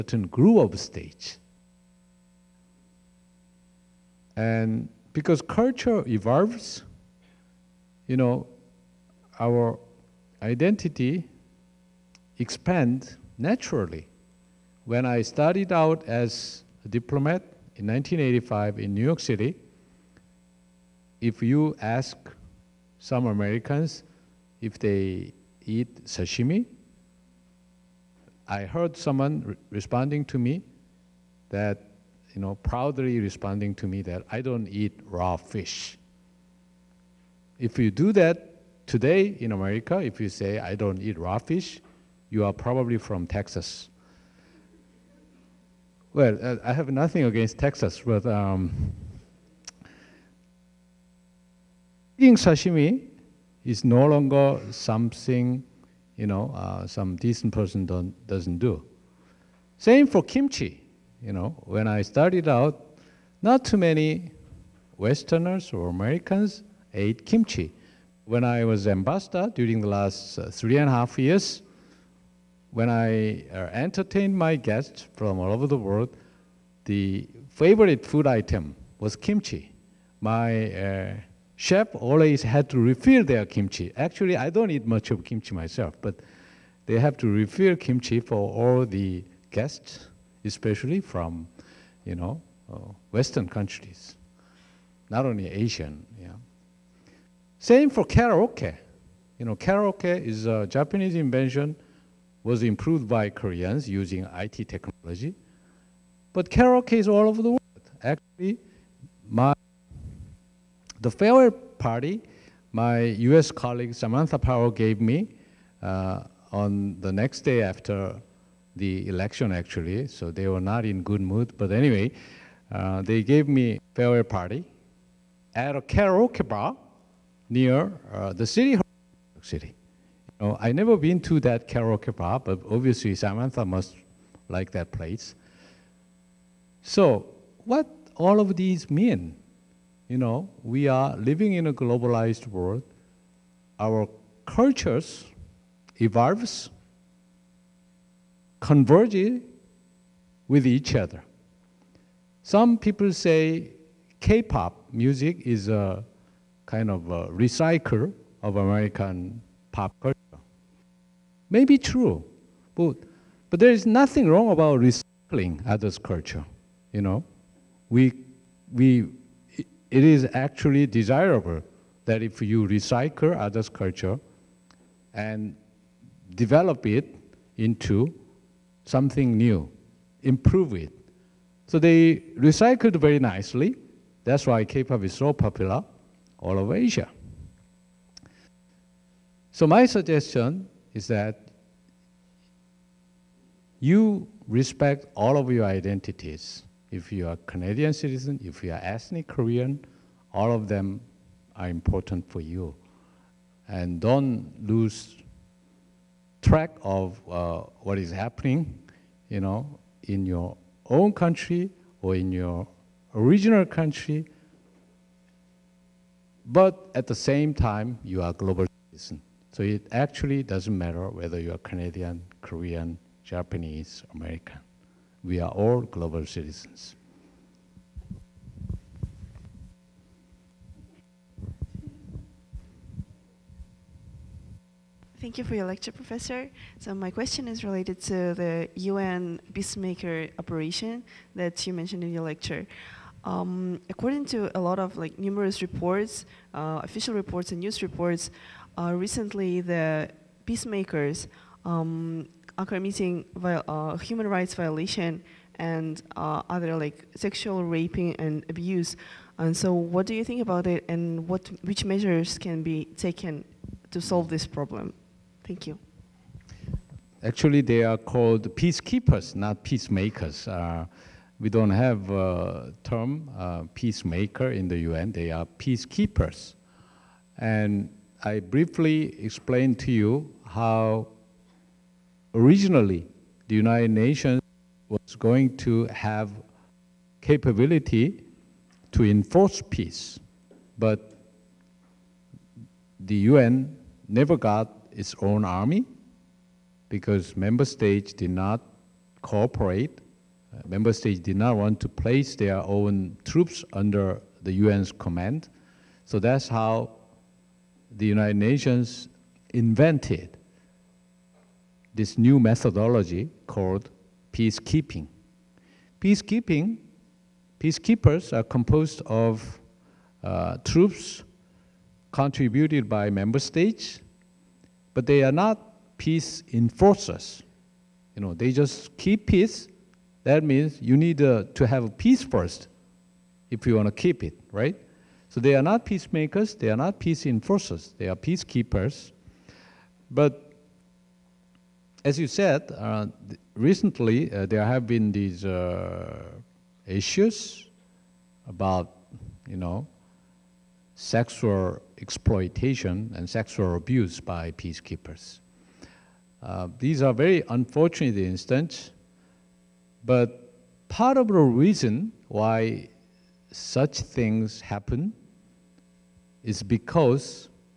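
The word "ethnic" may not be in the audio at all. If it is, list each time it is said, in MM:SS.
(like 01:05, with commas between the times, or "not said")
03:18.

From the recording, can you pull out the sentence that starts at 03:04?
That's why K-pop is so popular all over Asia.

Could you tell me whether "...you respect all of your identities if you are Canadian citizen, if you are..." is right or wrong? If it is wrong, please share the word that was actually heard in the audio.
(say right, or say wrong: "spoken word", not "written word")
right.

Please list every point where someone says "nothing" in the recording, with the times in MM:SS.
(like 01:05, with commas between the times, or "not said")
00:46, 02:43.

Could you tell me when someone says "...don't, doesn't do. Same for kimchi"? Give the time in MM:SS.
00:57.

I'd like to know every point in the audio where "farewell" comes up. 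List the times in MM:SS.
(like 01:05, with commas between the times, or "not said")
01:51, 02:03.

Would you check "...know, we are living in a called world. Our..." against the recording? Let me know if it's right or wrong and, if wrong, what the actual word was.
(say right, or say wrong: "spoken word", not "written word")
wrong: "globalized", not "called".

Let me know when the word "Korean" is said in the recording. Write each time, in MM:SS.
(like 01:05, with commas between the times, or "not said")
01:43, 03:19, 03:42.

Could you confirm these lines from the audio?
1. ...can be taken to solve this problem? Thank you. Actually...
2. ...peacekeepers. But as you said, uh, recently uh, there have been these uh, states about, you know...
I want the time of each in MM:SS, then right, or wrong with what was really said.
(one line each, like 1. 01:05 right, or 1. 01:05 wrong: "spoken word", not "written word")
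1. 04:22 right
2. 05:38 wrong: "issues", not "states".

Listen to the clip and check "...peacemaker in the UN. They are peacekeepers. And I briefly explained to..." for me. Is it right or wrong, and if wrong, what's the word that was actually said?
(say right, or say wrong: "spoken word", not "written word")
right.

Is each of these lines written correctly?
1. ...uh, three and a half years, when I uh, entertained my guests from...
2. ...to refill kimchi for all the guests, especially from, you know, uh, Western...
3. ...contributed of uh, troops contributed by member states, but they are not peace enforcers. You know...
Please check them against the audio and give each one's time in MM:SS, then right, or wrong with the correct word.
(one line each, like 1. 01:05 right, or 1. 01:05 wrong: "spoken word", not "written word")
1. 01:10 right
2. 01:27 right
3. 05:18 wrong: "composed", not "contributed".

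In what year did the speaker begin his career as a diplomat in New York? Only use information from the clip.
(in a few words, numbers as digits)
1985.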